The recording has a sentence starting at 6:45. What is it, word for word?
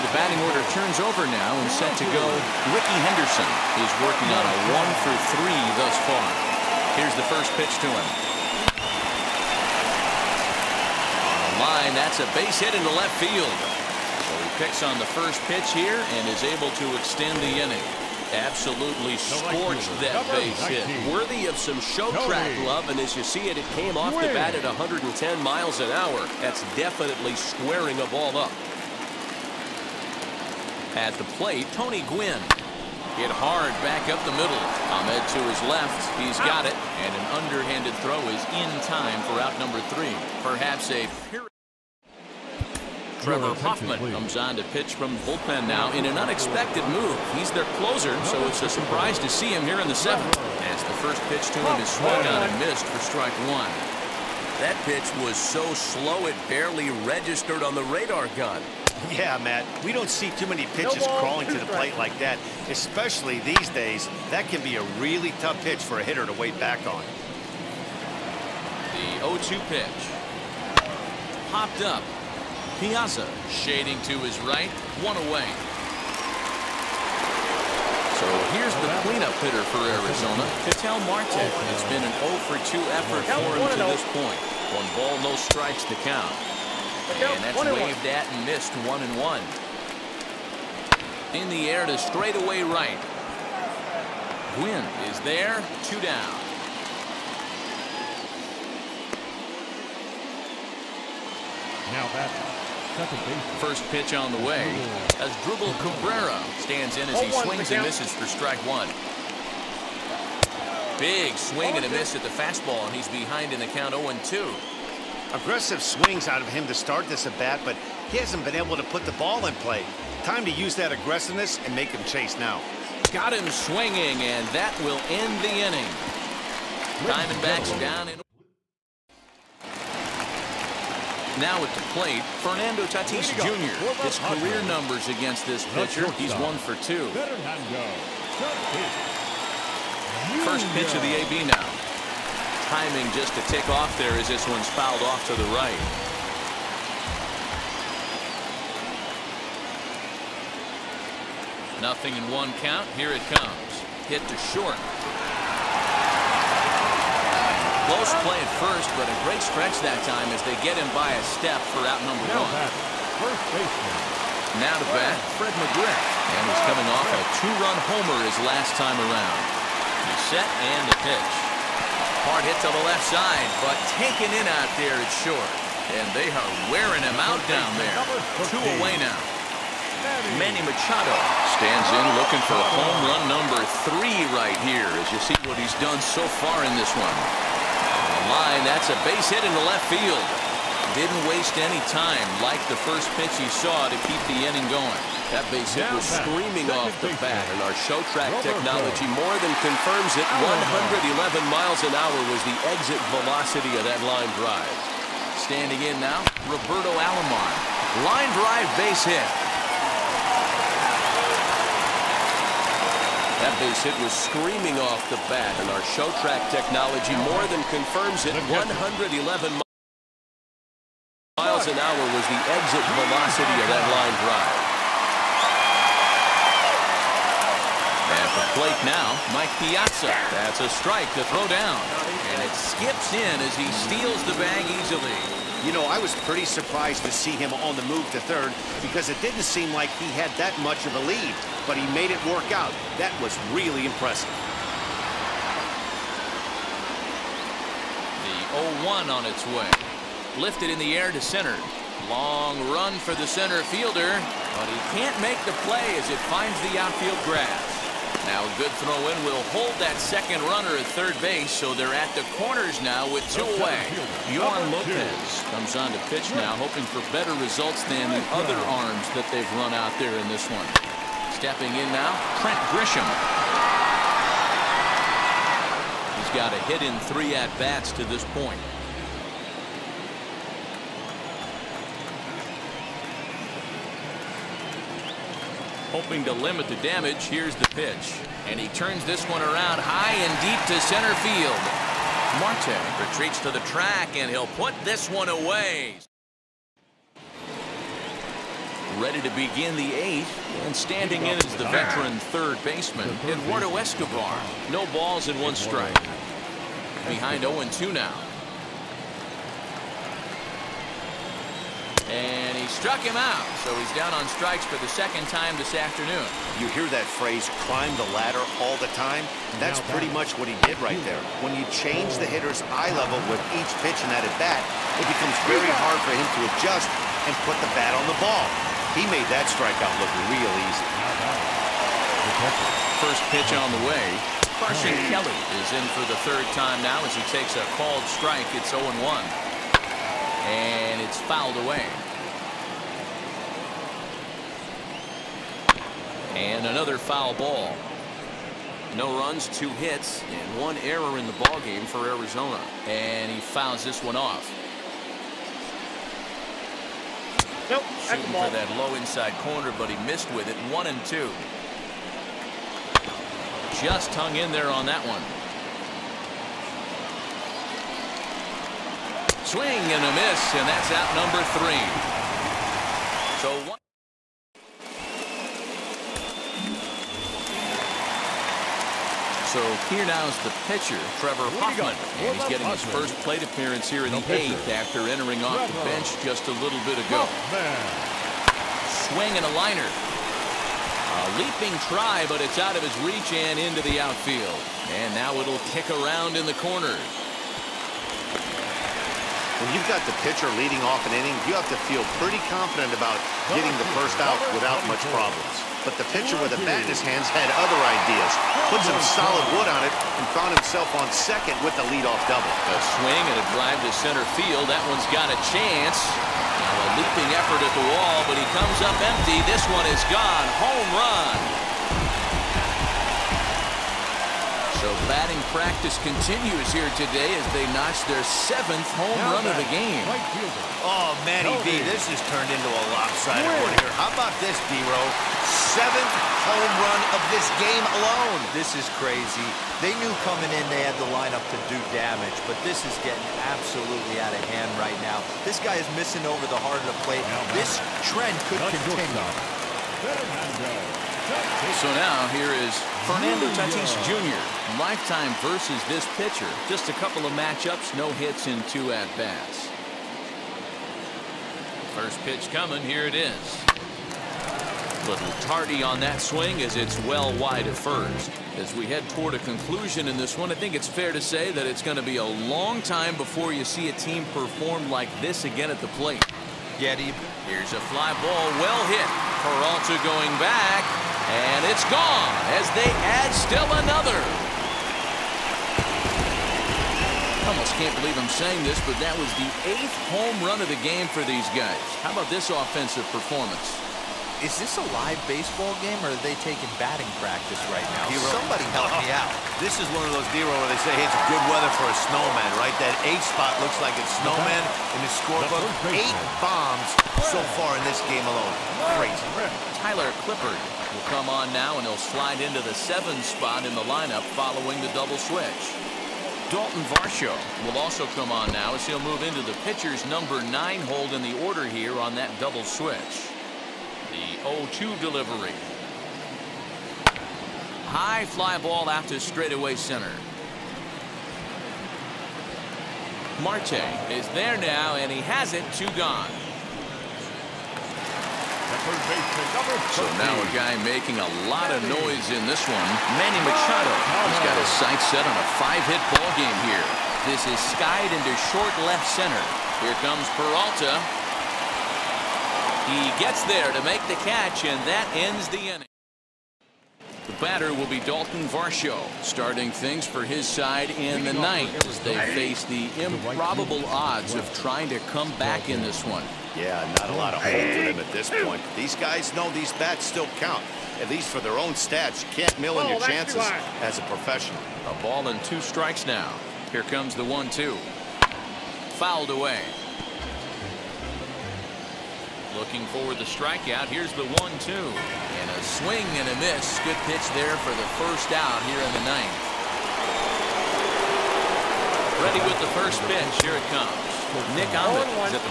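But the pitcher with a bat in his hands had other ideas.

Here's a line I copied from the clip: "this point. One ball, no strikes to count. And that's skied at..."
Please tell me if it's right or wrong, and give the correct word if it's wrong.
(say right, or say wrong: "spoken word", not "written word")
wrong: "waved", not "skied".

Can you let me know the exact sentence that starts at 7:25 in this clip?
This guy is missing over the heart of the plate.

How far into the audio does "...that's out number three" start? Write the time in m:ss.
6:10.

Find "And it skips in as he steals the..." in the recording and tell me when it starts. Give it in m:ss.
3:52.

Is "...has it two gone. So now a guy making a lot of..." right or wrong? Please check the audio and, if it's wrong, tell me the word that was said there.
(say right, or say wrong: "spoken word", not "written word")
right.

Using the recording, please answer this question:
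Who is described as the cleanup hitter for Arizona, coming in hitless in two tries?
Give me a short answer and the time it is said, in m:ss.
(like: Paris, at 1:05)
Ketel Marte, at 1:20.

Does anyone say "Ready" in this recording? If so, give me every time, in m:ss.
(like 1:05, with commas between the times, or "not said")
4:58, 9:52.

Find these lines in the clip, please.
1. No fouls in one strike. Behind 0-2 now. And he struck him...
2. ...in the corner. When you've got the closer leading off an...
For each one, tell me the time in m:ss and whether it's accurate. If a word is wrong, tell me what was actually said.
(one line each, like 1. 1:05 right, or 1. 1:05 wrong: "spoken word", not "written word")
1. 5:04 wrong: "balls", not "fouls"
2. 6:36 wrong: "pitcher", not "closer".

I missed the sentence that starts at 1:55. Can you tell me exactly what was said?
Aggressive swings out of him to start this at bat, but he hasn't been able to put the ball in play.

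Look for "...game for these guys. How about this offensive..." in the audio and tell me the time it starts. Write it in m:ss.
8:10.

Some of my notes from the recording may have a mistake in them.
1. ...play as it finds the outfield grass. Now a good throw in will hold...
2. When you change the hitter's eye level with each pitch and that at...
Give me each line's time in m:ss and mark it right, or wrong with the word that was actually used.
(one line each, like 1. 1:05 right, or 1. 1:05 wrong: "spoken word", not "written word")
1. 4:15 right
2. 5:21 right.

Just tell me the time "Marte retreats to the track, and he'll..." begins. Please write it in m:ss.
4:52.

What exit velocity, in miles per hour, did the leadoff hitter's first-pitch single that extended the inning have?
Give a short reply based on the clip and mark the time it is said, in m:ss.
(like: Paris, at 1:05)
110, at 0:24.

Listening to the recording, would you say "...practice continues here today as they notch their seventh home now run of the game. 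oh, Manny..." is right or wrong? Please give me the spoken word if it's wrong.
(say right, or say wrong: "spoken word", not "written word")
right.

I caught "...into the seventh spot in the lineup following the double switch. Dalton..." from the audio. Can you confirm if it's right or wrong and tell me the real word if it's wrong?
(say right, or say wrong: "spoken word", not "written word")
right.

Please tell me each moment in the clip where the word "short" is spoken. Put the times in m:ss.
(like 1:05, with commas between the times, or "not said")
2:34, 2:55, 9:08.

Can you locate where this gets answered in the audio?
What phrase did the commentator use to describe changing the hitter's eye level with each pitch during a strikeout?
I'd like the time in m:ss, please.
5:17.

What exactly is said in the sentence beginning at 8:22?
That eight spot looks like it's snowman in the scorebook.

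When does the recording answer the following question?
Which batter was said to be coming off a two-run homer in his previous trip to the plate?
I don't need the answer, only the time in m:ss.
2:45.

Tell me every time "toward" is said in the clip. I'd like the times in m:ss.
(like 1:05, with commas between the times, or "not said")
7:49.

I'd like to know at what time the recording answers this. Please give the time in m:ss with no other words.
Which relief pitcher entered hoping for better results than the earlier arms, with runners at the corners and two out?
4:24.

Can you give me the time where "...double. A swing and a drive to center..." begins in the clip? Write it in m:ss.
6:52.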